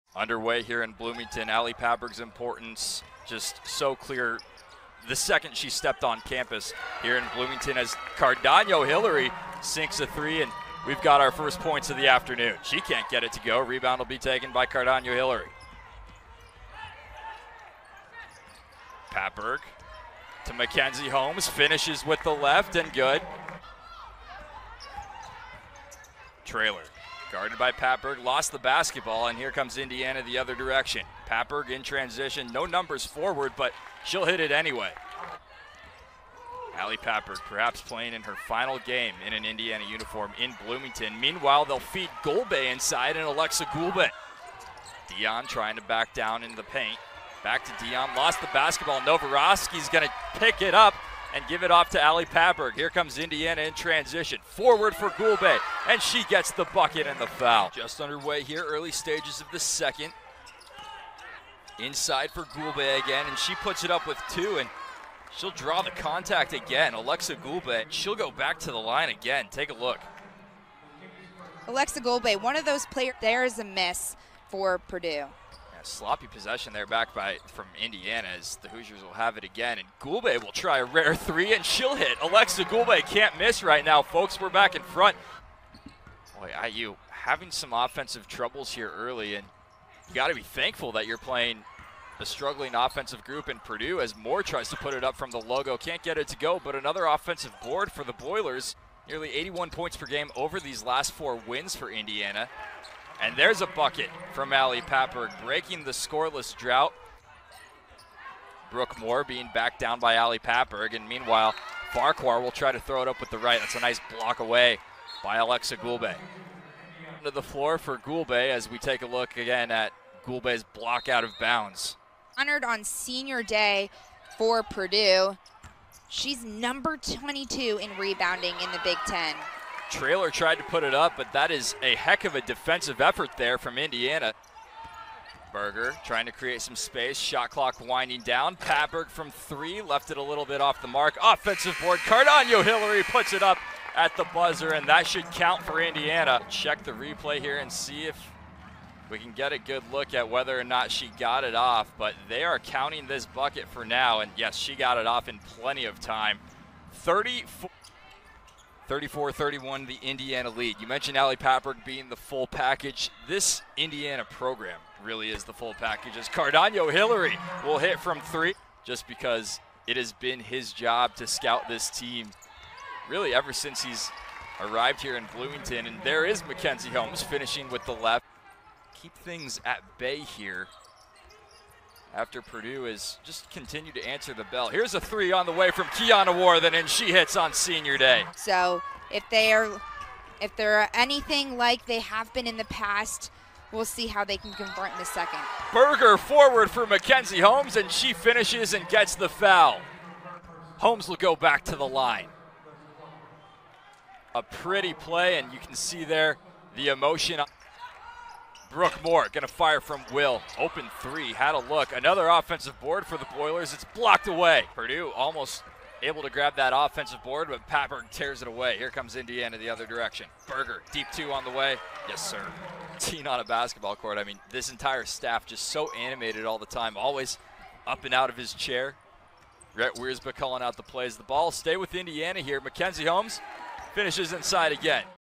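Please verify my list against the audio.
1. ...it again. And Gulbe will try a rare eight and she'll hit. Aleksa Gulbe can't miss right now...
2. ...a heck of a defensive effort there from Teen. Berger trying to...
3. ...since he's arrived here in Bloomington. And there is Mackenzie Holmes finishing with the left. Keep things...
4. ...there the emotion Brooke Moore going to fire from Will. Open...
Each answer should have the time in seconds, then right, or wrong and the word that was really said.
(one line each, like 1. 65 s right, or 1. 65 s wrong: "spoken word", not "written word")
1. 79 s wrong: "three", not "eight"
2. 131 s wrong: "Indiana", not "Teen"
3. 173 s right
4. 206 s right.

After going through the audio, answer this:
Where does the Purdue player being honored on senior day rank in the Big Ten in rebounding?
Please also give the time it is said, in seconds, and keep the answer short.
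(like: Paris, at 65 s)
22, at 126 s.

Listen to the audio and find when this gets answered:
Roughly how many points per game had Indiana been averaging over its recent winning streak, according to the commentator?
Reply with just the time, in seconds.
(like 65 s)
99 s.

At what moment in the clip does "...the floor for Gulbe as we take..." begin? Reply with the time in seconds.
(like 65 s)
117 s.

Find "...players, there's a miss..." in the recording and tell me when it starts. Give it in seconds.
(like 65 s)
72 s.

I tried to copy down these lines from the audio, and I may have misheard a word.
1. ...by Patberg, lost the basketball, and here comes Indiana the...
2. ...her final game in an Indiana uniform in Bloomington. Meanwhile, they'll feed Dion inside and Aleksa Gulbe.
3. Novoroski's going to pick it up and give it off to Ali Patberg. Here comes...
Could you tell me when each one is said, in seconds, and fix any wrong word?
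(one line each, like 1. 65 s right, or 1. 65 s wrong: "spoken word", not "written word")
1. 27 s right
2. 38 s wrong: "Gulbe", not "Dion"
3. 49 s right.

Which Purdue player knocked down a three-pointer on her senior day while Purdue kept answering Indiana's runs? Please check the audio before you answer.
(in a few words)
Kiana Warthen.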